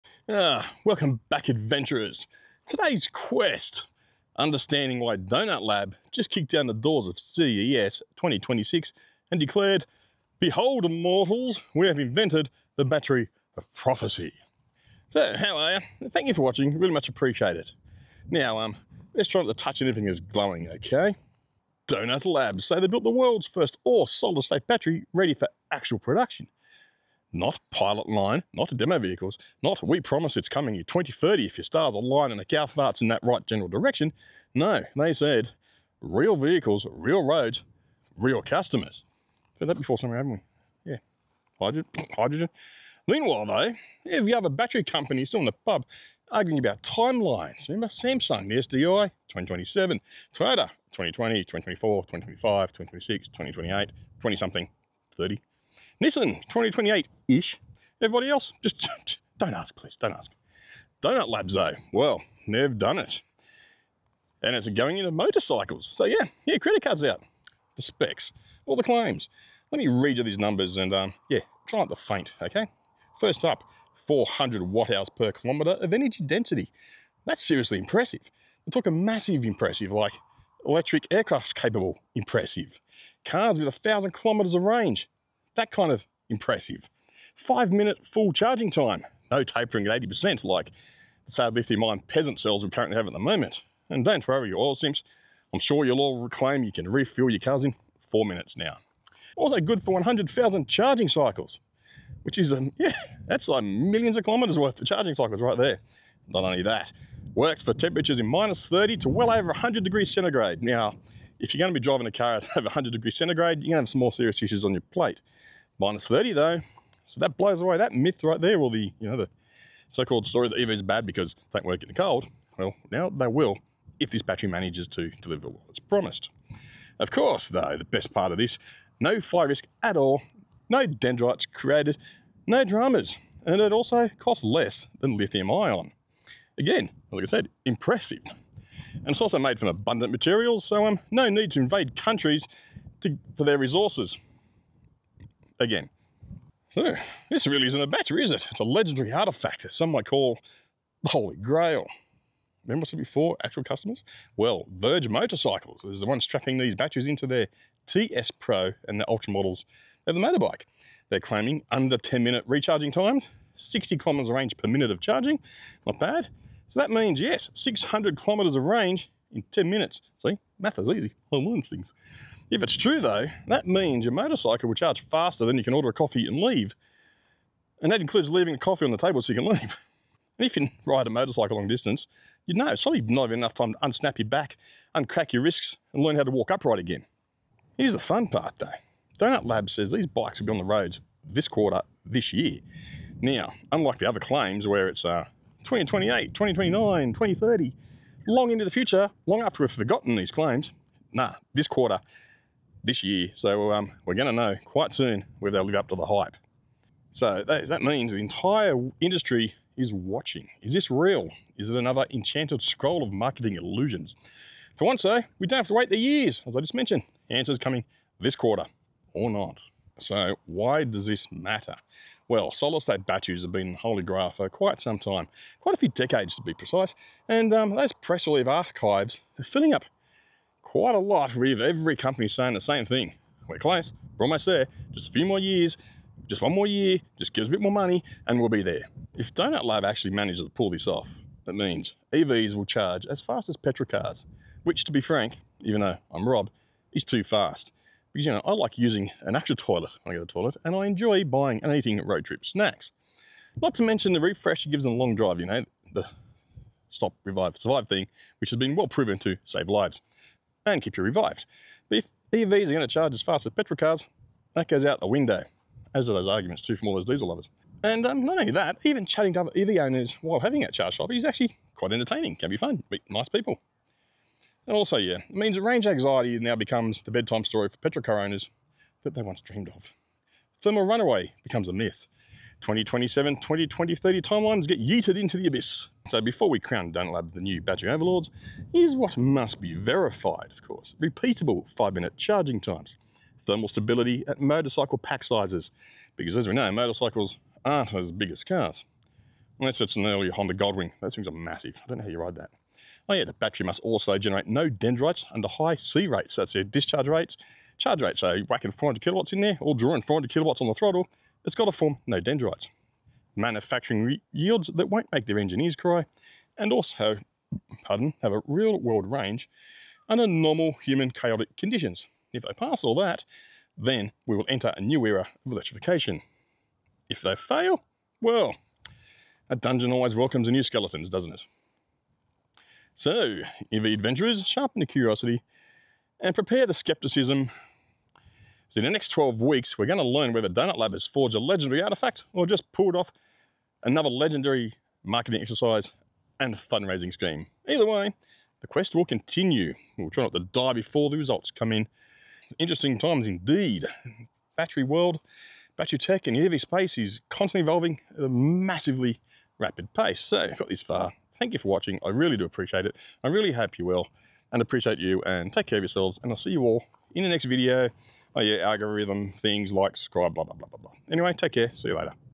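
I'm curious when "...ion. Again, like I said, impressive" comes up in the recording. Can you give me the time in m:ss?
2:15.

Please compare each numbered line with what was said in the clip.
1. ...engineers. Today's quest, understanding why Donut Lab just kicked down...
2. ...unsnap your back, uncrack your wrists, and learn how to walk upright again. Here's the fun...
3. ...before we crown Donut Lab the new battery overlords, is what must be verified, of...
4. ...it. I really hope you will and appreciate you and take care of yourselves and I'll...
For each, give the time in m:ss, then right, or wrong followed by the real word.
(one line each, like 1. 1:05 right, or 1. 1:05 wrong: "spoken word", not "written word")
1. 0:01 wrong: "adventurers", not "engineers"
2. 3:03 right
3. 4:46 right
4. 6:02 right.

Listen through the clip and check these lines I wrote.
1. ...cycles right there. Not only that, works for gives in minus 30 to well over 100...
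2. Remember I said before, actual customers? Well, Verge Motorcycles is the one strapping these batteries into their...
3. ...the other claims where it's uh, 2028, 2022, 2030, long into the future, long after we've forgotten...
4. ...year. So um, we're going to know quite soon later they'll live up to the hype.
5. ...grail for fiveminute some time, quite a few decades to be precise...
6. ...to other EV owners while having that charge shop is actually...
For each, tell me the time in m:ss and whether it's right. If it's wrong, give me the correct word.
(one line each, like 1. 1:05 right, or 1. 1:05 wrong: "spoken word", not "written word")
1. 1:45 wrong: "temperatures", not "gives"
2. 2:32 right
3. 3:13 wrong: "2029", not "2022"
4. 3:23 wrong: "whether", not "later"
5. 3:44 wrong: "quite", not "fiveminute"
6. 4:29 right.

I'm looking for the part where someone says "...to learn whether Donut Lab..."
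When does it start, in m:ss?
5:39.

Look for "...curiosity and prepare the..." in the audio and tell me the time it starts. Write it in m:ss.
5:34.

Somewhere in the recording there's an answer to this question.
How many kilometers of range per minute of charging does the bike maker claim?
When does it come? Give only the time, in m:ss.
2:43.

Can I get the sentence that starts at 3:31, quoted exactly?
Is it another enchanted scroll of marketing illusions?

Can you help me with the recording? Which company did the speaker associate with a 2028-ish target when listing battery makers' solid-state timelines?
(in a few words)
Nissan.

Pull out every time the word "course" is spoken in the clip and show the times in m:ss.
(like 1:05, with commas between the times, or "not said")
2:07, 4:50.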